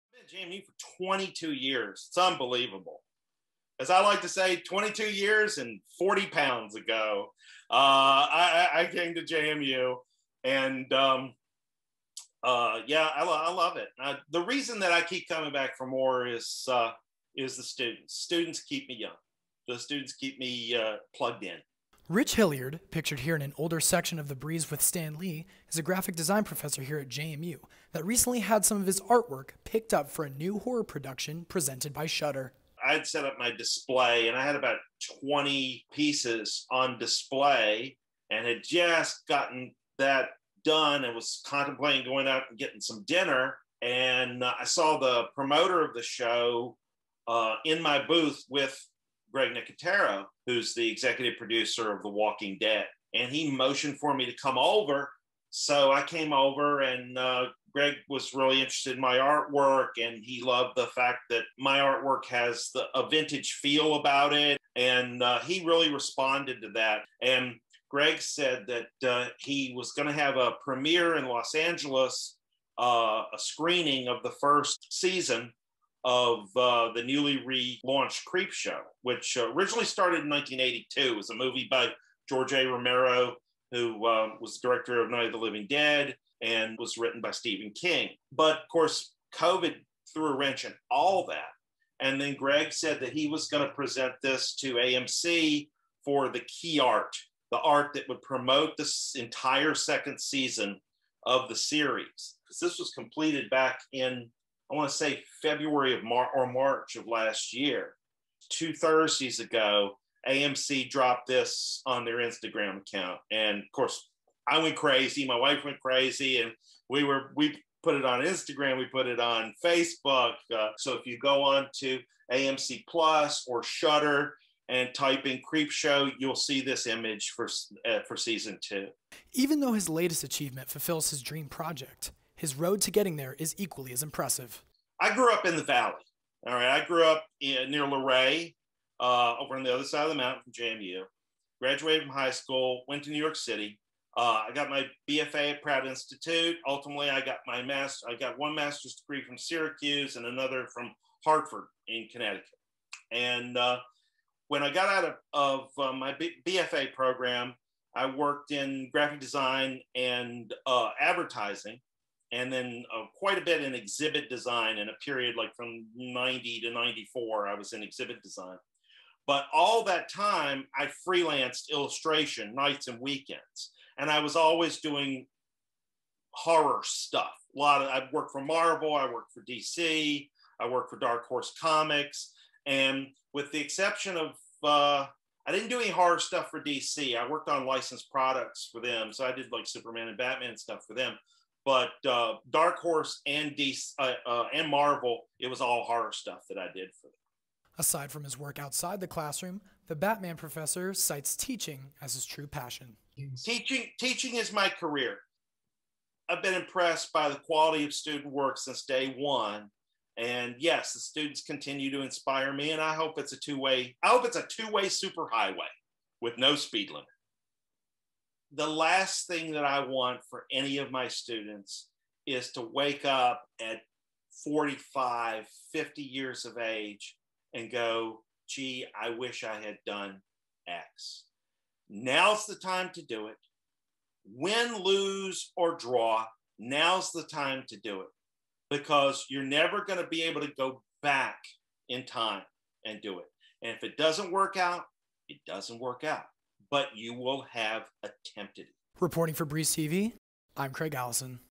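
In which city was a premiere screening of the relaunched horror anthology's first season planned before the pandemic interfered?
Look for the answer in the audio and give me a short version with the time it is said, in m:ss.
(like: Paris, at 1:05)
Los Angeles, at 1:11.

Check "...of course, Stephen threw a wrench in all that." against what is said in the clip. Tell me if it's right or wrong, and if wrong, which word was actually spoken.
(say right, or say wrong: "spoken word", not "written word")
wrong: "COVID", not "Stephen".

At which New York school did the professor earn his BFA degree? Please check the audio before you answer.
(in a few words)
Pratt Institute.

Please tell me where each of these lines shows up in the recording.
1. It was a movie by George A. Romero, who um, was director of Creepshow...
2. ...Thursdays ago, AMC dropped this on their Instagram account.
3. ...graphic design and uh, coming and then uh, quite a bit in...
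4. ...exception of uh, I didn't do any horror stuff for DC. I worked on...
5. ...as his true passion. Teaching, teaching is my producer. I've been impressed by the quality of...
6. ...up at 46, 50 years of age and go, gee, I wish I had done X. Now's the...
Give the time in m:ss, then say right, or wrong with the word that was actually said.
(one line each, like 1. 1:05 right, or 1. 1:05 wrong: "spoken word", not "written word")
1. 1:21 wrong: "Night", not "Creepshow"
2. 1:48 right
3. 2:38 wrong: "advertising", not "coming"
4. 3:03 right
5. 3:22 wrong: "career", not "producer"
6. 3:43 wrong: "45", not "46".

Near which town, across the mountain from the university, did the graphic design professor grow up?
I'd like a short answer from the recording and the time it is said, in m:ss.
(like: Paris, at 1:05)
Luray, at 2:17.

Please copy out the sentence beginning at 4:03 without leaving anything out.
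And if it doesn't work out, it doesn't work out but you will have attempted it.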